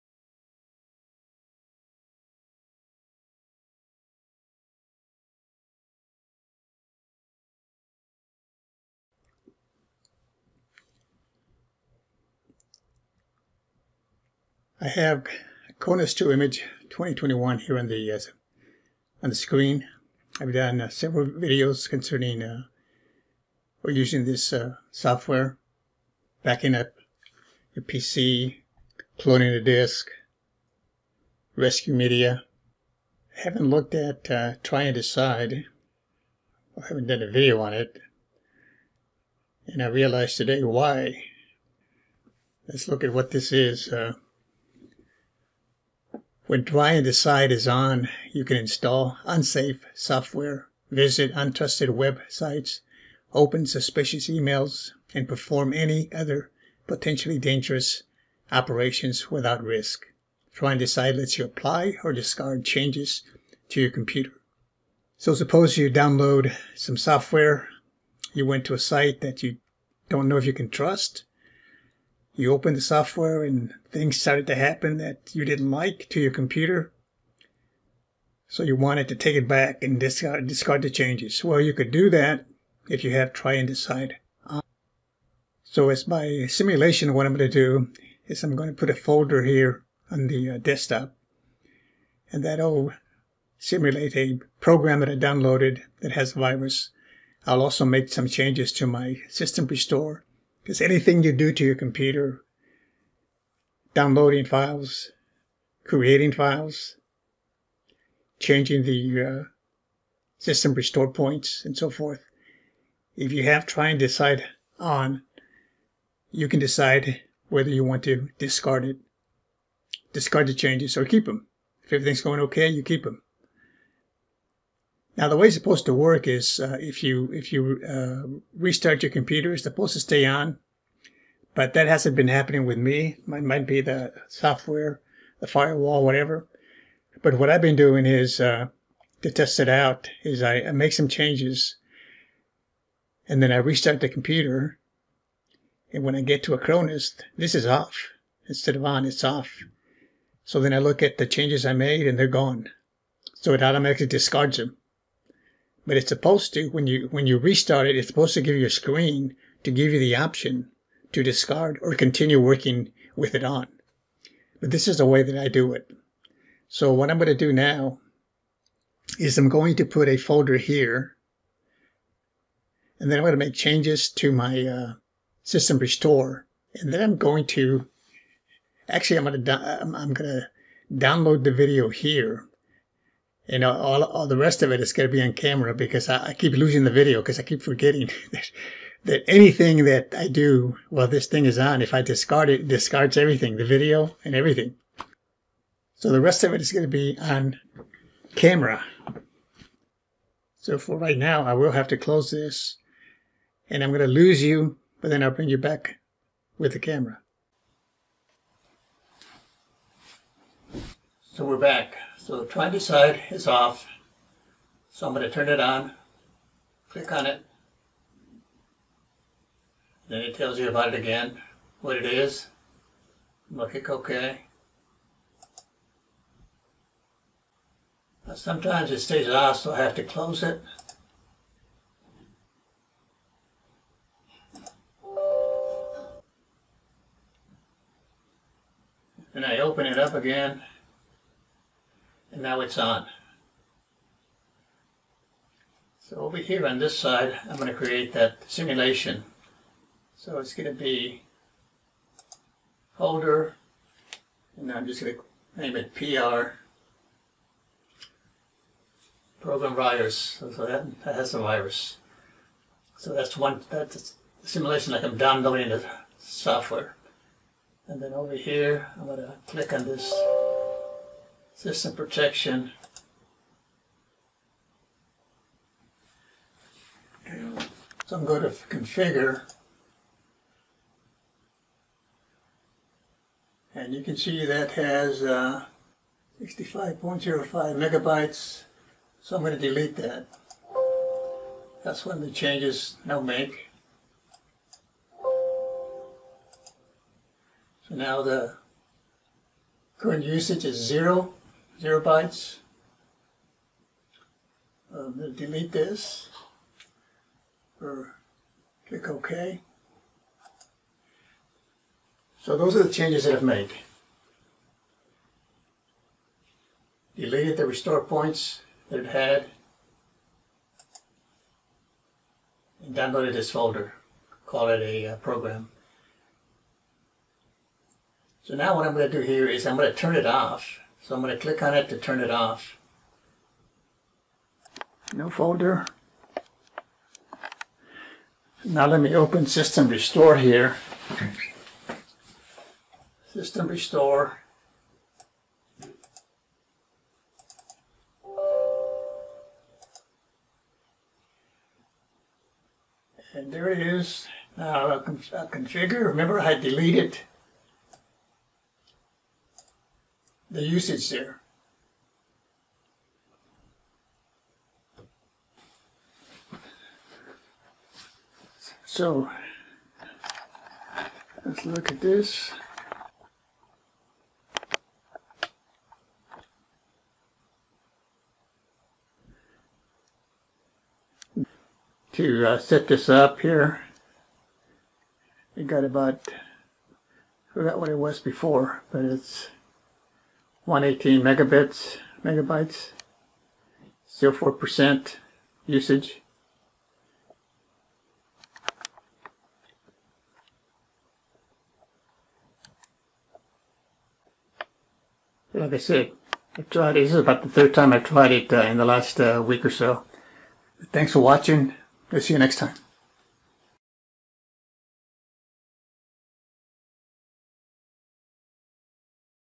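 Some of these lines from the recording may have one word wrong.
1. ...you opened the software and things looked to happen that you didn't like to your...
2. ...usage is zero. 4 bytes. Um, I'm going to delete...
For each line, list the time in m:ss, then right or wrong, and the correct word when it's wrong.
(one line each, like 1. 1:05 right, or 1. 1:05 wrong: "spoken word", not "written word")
1. 1:12 wrong: "started", not "looked"
2. 5:00 wrong: "0", not "4".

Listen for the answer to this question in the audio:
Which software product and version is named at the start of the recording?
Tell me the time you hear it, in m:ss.
0:15.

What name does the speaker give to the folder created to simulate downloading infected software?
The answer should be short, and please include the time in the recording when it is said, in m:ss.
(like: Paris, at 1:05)
PR program virus, at 4:15.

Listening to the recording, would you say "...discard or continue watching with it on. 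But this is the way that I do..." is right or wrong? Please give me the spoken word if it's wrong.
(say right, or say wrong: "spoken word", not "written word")
wrong: "working", not "watching".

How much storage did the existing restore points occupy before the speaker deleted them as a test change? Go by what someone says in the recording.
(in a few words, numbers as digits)
65.05 megabytes.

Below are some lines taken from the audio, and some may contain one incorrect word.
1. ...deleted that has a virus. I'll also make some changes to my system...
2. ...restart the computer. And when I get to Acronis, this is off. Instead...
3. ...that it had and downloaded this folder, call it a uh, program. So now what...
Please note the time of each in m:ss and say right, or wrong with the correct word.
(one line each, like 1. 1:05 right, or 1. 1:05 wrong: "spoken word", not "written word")
1. 1:35 wrong: "downloaded", not "deleted"
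2. 2:23 right
3. 5:18 right.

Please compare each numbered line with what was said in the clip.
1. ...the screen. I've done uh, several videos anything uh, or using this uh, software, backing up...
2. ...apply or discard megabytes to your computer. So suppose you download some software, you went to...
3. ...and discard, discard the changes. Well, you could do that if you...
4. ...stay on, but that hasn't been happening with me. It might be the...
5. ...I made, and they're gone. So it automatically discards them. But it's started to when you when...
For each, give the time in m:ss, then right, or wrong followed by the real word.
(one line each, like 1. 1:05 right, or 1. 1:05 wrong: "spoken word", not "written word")
1. 0:19 wrong: "concerning", not "anything"
2. 1:01 wrong: "changes", not "megabytes"
3. 1:19 right
4. 2:09 right
5. 2:31 wrong: "supposed", not "started".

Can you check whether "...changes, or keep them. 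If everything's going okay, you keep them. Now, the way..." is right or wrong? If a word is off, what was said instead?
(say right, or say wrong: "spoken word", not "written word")
right.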